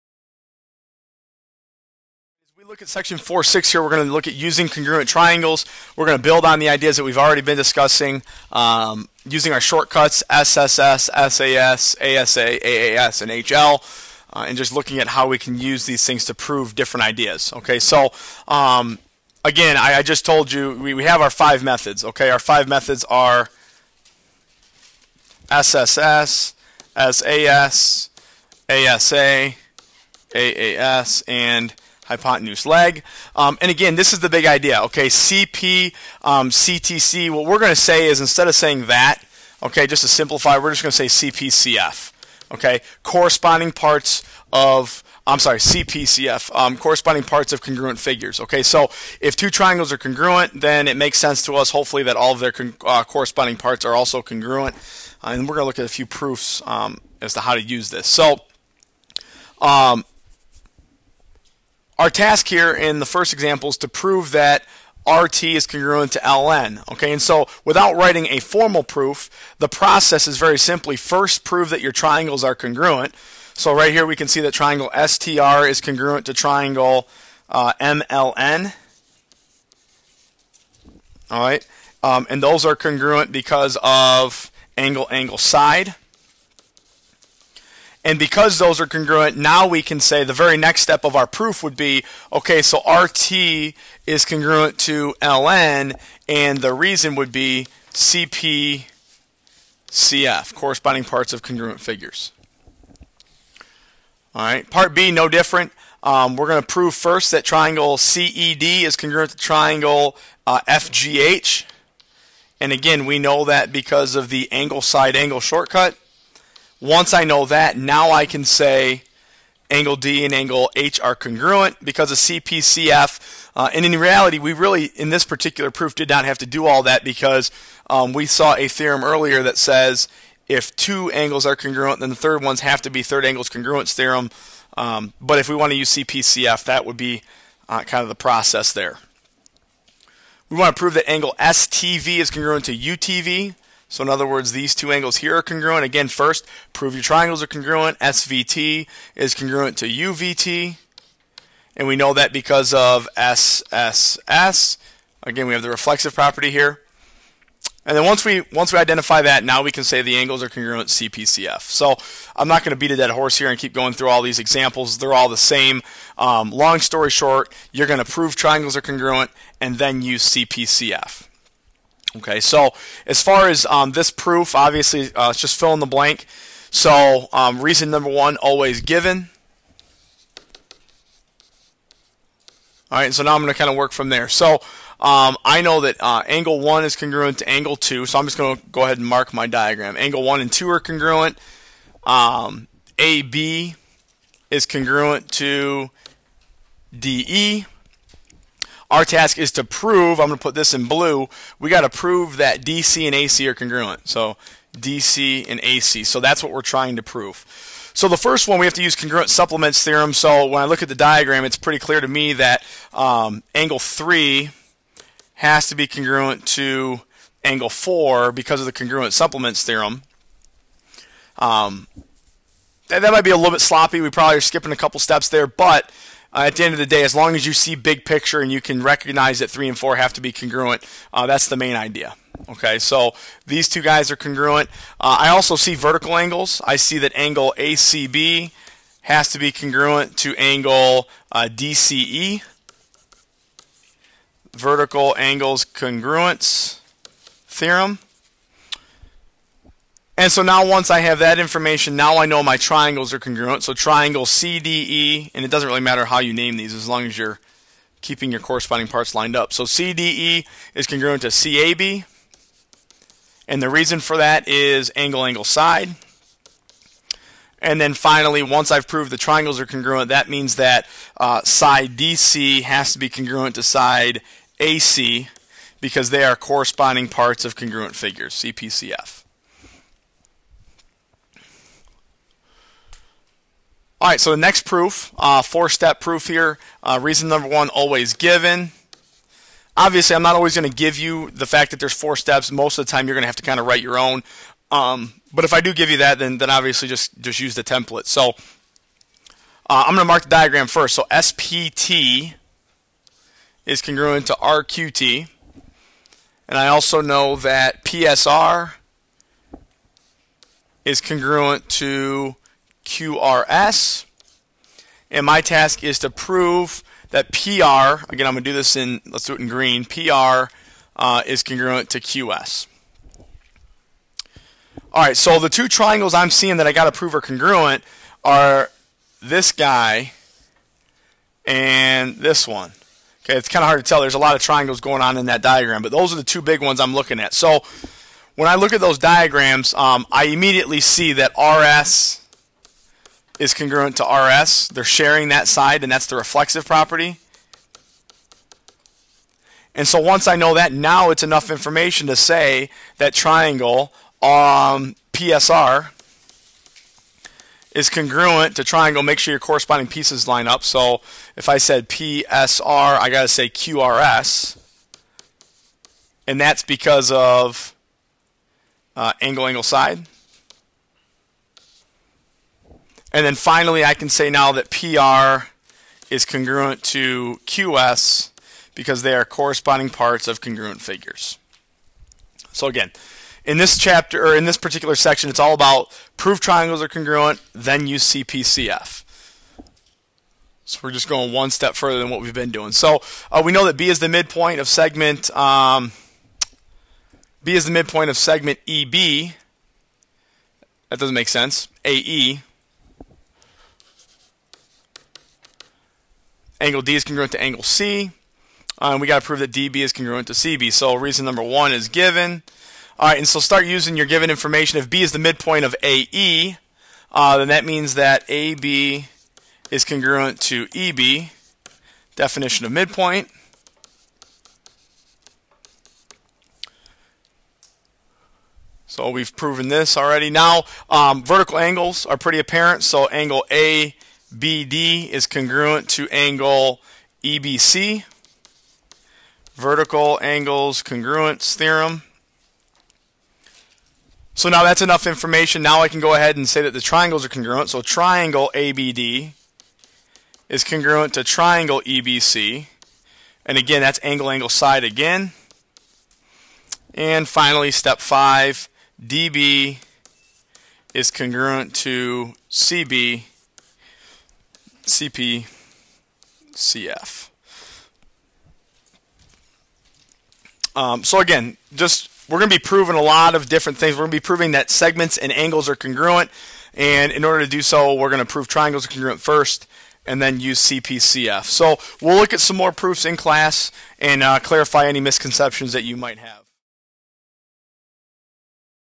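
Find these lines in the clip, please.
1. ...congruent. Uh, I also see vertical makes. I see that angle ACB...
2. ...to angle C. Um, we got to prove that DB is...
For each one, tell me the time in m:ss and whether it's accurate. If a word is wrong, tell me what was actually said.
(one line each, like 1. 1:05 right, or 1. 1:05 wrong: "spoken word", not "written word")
1. 3:54 wrong: "angles", not "makes"
2. 6:47 right.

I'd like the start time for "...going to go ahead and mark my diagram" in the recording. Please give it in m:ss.
3:08.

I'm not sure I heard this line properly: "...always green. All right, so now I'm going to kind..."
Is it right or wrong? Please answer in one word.
wrong.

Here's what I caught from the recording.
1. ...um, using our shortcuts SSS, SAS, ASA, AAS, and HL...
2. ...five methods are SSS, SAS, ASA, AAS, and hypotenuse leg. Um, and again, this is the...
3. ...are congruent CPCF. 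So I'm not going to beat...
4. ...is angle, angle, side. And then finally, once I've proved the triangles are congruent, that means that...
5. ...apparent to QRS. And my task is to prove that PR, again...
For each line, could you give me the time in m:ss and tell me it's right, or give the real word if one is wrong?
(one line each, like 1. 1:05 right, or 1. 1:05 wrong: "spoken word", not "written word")
1. 0:08 right
2. 0:22 right
3. 2:40 right
4. 4:24 right
5. 5:11 wrong: "congruent", not "apparent".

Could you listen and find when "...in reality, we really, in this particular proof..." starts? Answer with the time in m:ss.
2:03.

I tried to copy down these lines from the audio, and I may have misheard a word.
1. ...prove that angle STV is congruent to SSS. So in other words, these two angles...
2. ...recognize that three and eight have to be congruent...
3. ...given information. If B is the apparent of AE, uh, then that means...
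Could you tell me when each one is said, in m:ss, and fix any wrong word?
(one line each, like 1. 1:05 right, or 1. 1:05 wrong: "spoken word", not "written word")
1. 2:20 wrong: "UTV", not "SSS"
2. 3:48 wrong: "four", not "eight"
3. 6:54 wrong: "midpoint", not "apparent".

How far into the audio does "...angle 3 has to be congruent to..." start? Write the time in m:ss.
3:33.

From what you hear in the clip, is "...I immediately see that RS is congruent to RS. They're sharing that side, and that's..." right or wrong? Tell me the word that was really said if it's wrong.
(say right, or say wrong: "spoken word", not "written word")
right.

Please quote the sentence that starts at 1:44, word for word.
All right, part B, no different.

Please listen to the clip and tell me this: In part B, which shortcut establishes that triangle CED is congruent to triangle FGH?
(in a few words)
angle side angle.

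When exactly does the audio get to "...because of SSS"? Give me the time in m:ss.
2:32.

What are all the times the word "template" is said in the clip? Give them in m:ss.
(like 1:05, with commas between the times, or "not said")
4:57.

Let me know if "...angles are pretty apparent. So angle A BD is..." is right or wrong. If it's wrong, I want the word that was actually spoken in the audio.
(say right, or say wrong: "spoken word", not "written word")
right.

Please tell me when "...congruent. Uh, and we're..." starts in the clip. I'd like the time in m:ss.
0:54.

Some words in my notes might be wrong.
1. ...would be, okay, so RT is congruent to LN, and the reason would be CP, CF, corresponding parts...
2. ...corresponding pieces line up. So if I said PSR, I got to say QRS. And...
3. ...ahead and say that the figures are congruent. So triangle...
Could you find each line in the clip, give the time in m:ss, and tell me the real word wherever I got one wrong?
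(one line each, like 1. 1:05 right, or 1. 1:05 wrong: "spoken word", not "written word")
1. 1:31 right
2. 5:59 right
3. 7:26 wrong: "triangles", not "figures".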